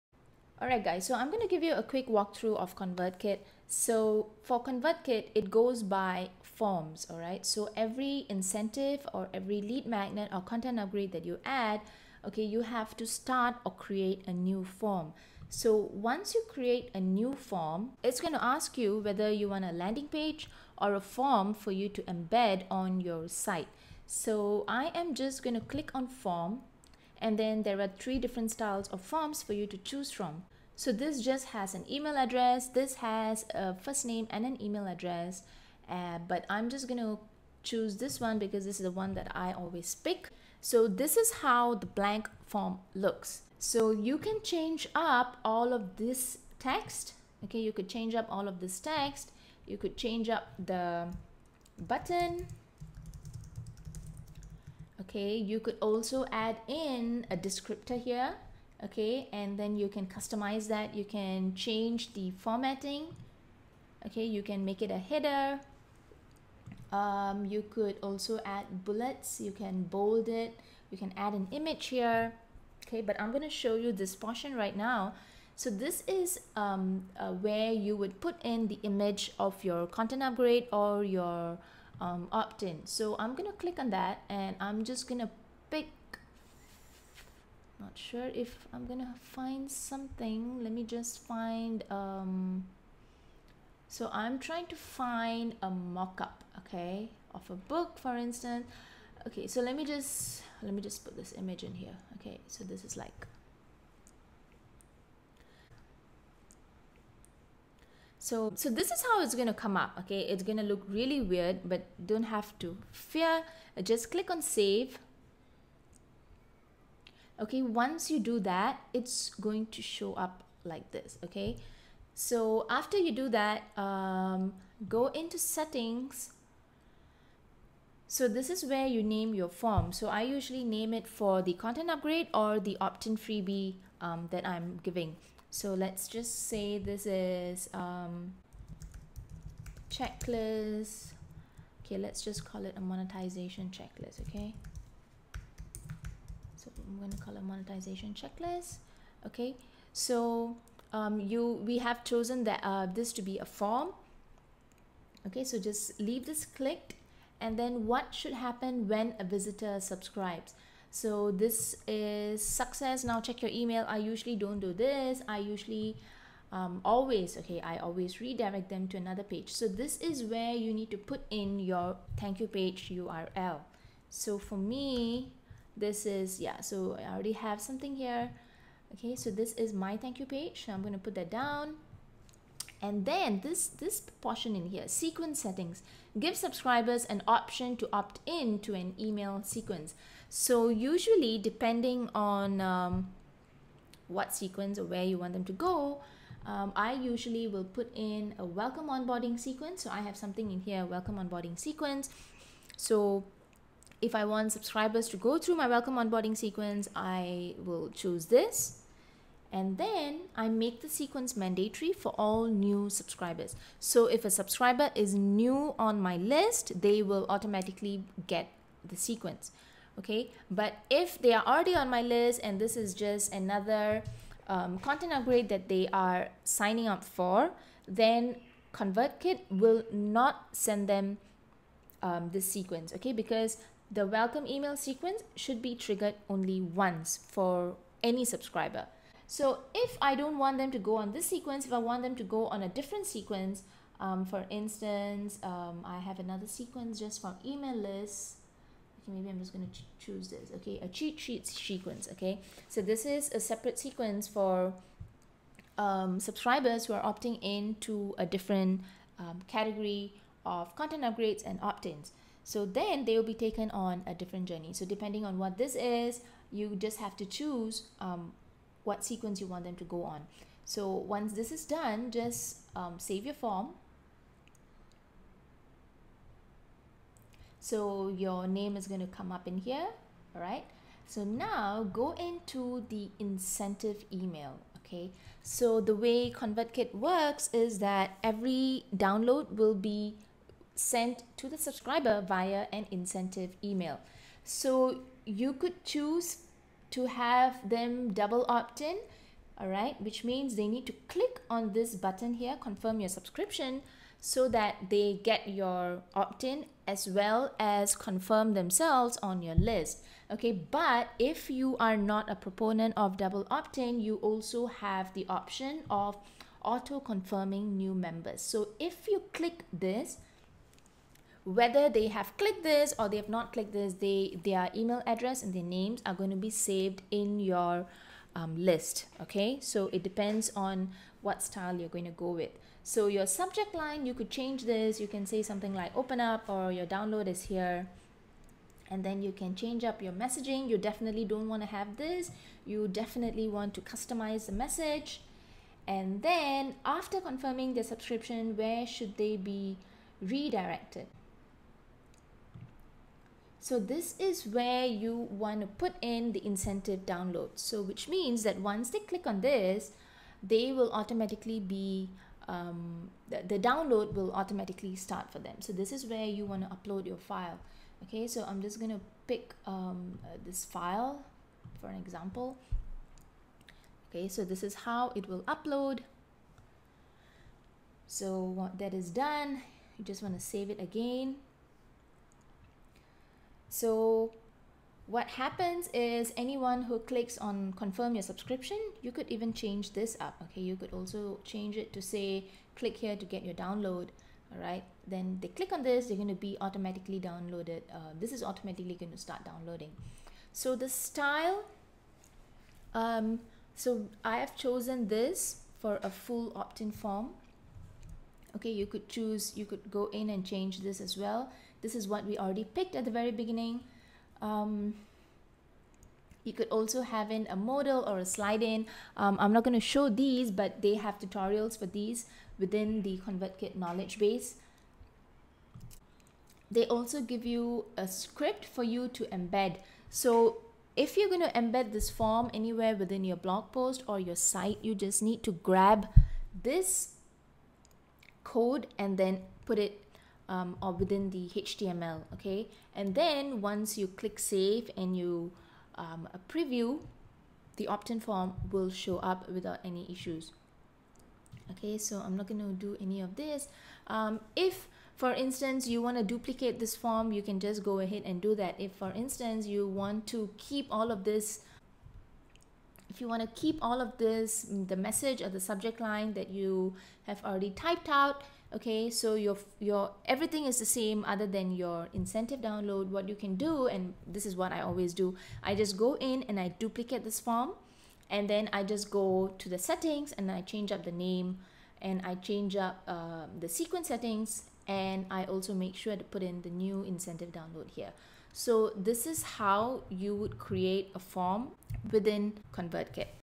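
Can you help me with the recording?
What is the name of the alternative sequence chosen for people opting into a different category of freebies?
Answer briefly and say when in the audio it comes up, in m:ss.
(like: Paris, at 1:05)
Cheat sheet sequence, at 4:10.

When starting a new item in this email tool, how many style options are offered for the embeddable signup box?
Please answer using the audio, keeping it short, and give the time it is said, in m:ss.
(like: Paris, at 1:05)
3, at 0:27.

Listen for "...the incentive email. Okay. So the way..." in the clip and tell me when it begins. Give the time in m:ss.
4:42.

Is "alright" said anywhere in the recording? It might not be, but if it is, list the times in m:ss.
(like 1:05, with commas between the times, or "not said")
0:00, 0:07.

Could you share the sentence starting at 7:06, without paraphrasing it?
They also give you a script for you to embed.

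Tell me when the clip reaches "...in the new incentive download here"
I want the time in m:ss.
8:06.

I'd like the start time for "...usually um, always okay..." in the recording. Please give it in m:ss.
2:45.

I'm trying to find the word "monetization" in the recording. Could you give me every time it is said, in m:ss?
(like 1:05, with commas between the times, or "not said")
2:22, 2:27.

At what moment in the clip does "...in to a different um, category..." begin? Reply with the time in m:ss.
4:17.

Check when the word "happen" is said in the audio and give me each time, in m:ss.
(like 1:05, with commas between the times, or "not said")
2:38, 6:25.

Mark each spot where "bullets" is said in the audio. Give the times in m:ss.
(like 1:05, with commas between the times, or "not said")
1:08.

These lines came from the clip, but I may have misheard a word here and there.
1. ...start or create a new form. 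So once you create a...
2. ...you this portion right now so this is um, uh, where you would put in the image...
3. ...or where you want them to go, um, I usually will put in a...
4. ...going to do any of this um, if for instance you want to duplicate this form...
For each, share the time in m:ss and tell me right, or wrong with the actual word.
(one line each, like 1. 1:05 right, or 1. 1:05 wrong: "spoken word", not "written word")
1. 0:13 right
2. 1:13 right
3. 3:14 right
4. 7:32 right.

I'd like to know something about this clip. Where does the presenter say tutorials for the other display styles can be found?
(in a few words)
ConvertKit knowledge base.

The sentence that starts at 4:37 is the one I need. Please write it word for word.
So your name is going to come up in here.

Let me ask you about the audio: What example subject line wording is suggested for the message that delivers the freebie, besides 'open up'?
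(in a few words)
Your download is here.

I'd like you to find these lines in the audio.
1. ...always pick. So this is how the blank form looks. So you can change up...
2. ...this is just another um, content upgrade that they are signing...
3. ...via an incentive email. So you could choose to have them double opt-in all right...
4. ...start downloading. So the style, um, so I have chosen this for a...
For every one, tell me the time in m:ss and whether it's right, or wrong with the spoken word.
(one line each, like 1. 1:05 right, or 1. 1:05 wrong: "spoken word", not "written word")
1. 0:39 right
2. 3:42 right
3. 4:52 right
4. 6:39 right.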